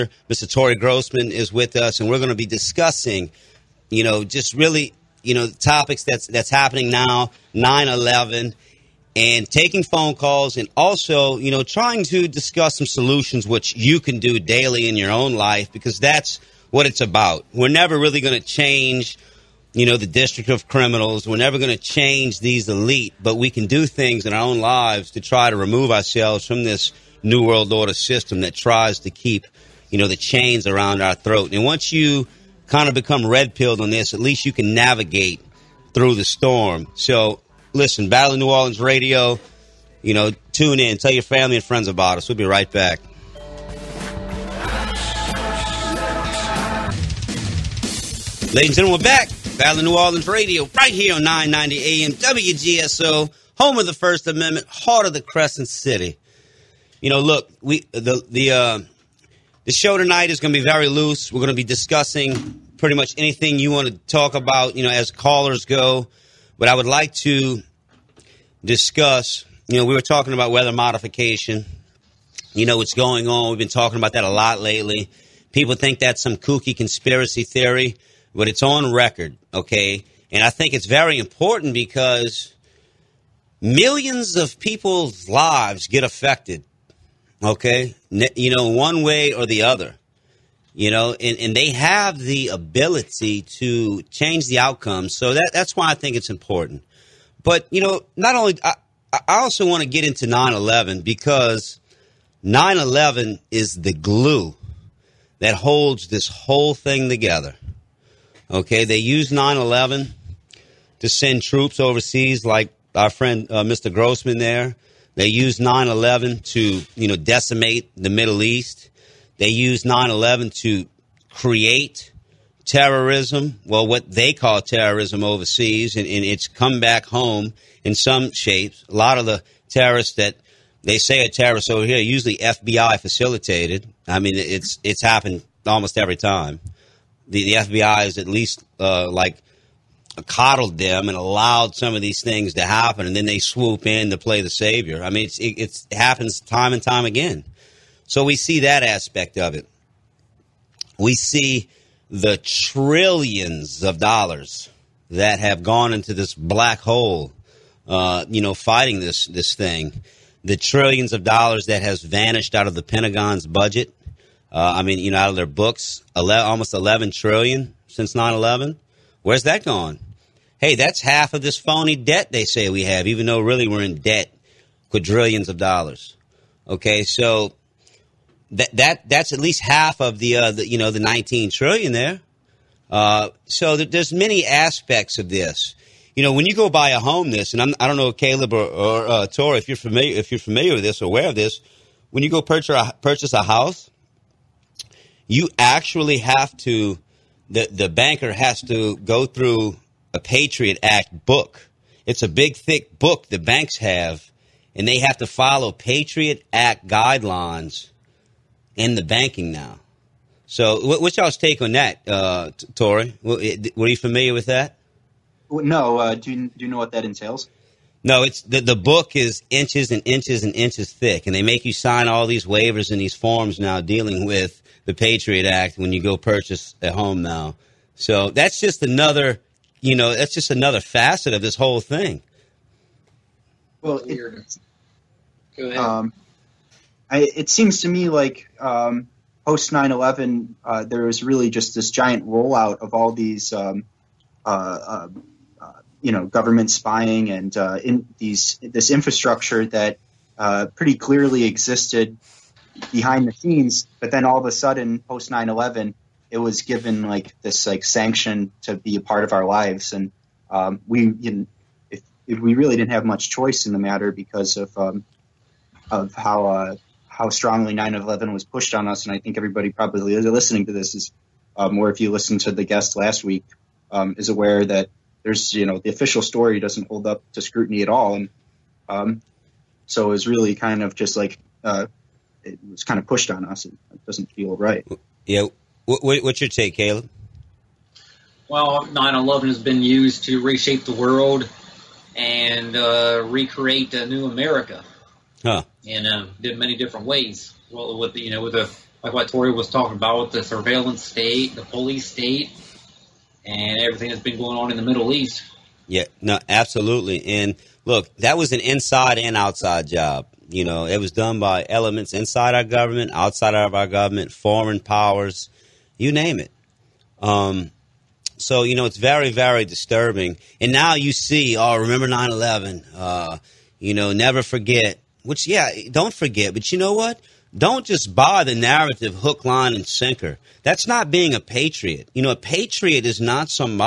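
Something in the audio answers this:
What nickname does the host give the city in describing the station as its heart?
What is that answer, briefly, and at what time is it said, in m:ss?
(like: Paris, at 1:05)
Crescent City, at 0:55.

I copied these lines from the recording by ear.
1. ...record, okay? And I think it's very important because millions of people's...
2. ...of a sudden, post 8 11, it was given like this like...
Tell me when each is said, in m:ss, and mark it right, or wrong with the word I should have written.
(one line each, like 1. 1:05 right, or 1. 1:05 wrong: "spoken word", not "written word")
1. 1:18 right
2. 4:14 wrong: "9", not "8".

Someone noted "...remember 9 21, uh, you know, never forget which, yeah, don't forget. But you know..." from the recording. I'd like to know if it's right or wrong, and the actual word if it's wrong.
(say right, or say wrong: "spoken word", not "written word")
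wrong: "11", not "21".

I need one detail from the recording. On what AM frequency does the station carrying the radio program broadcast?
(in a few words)
990 AM.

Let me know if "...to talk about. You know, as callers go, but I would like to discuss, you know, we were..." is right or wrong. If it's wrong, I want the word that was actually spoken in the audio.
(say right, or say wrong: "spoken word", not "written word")
right.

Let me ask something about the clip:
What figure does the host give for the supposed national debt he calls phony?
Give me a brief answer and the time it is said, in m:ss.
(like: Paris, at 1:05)
19 trillion, at 3:00.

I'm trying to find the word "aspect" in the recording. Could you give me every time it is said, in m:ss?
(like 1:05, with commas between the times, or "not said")
2:28, 3:04.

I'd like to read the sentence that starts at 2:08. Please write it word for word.
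A lot of the terrorists that they say are terrorists over here, usually FBI facilitated.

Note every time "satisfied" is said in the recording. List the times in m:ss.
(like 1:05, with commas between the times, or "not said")
not said.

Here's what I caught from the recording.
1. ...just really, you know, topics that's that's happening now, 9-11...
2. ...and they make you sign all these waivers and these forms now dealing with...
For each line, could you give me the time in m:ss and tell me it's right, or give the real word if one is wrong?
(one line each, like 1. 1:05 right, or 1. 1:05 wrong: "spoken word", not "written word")
1. 0:04 right
2. 3:41 right.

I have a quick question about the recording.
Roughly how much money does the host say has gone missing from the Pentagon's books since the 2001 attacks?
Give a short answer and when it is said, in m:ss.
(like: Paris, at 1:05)
almost 11 trillion, at 2:46.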